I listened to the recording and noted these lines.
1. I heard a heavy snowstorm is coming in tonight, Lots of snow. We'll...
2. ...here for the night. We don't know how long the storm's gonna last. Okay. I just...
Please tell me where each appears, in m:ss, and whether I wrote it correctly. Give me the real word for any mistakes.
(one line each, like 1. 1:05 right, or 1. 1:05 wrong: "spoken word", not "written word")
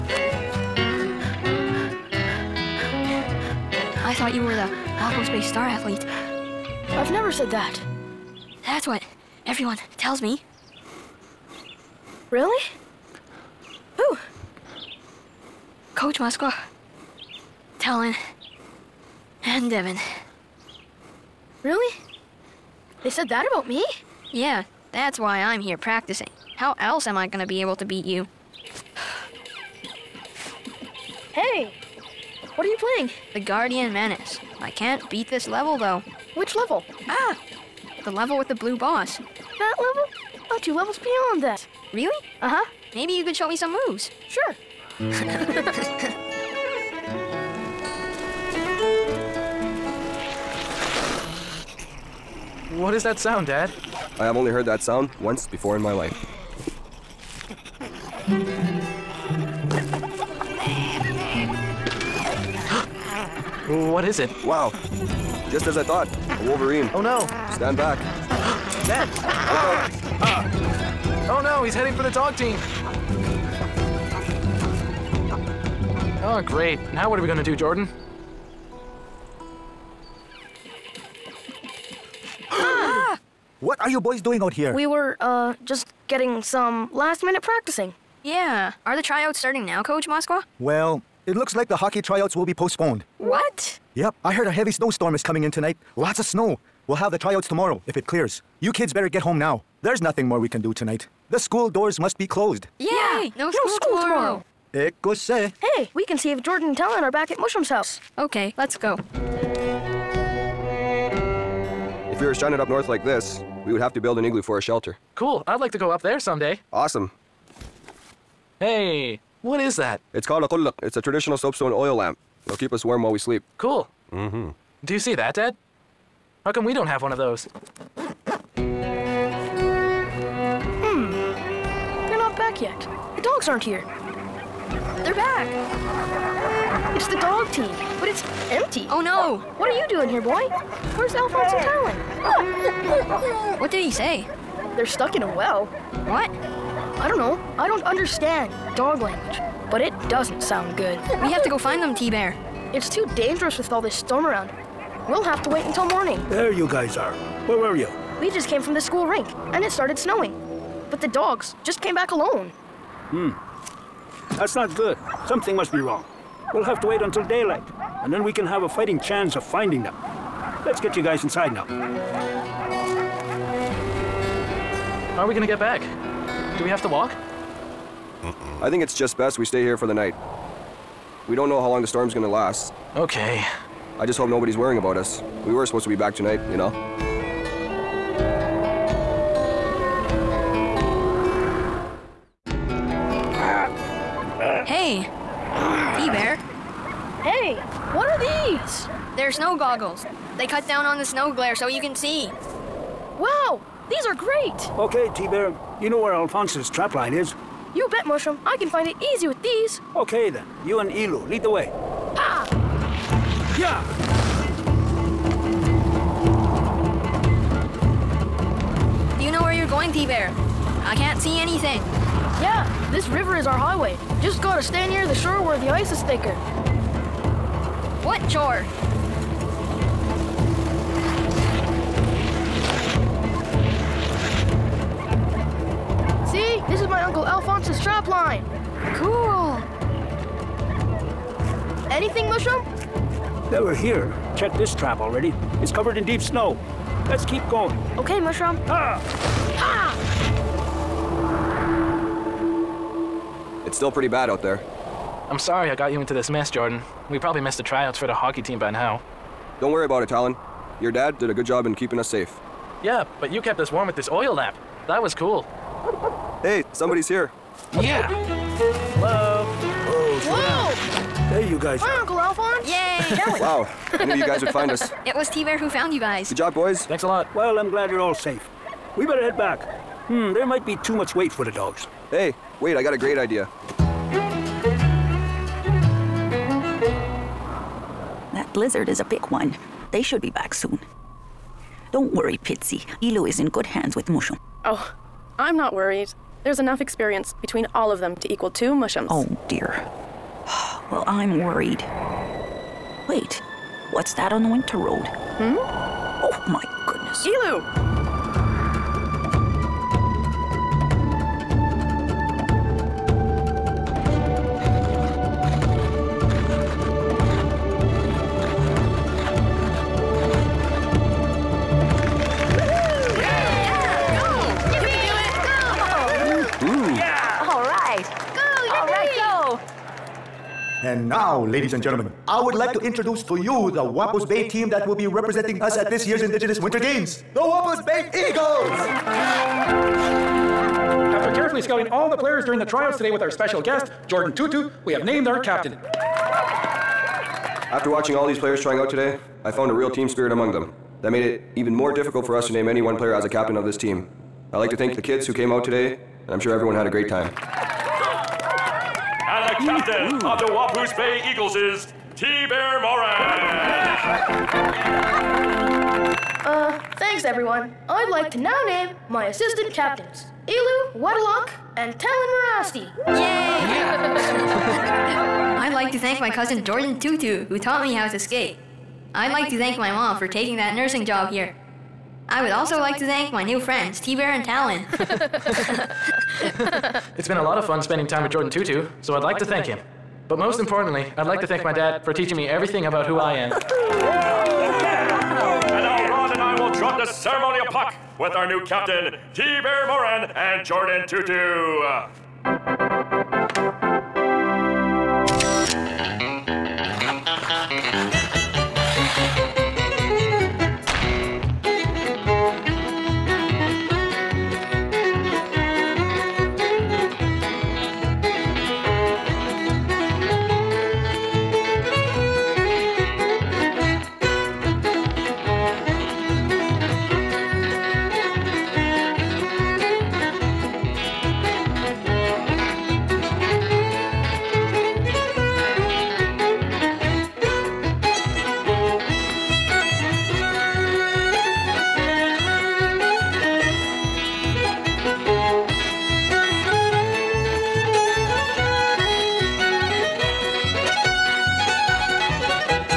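1. 1:34 right
2. 2:59 right.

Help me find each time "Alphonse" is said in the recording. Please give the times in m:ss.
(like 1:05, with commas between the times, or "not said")
2:21, 3:26, 3:57, 4:32.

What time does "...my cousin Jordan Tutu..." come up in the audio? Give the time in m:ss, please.
6:16.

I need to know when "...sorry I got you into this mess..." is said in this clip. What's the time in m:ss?
4:15.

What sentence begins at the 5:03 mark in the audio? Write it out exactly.
What's that on the winter road?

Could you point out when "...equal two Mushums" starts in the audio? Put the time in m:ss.
4:58.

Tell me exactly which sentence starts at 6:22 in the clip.
I would also like to thank my new friends, T-Bear and Talon.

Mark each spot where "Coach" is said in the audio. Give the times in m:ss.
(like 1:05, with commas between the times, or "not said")
0:15, 1:29.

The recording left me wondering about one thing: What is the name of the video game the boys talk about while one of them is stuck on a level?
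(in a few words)
The Guardian Menace.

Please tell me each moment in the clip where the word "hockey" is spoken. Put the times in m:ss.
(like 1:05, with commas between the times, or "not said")
1:31, 4:18.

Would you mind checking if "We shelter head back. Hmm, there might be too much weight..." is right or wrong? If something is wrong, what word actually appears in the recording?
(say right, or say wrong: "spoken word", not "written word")
wrong: "better", not "shelter".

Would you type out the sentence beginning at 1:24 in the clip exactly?
We were, uh, just getting some last minute practicing.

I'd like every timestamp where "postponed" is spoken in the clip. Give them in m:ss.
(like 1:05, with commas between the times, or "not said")
1:32.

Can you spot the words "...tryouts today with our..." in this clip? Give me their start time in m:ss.
5:42.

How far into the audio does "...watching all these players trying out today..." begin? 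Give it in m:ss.
5:47.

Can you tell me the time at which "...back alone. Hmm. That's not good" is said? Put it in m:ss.
2:41.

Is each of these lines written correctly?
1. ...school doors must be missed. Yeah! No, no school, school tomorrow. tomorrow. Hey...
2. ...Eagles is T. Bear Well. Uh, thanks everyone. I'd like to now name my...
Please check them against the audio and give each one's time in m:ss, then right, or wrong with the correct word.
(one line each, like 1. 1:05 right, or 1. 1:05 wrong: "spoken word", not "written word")
1. 1:41 wrong: "closed", not "missed"
2. 6:01 wrong: "Moran", not "Well".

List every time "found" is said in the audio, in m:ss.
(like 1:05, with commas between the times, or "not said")
4:35, 5:49.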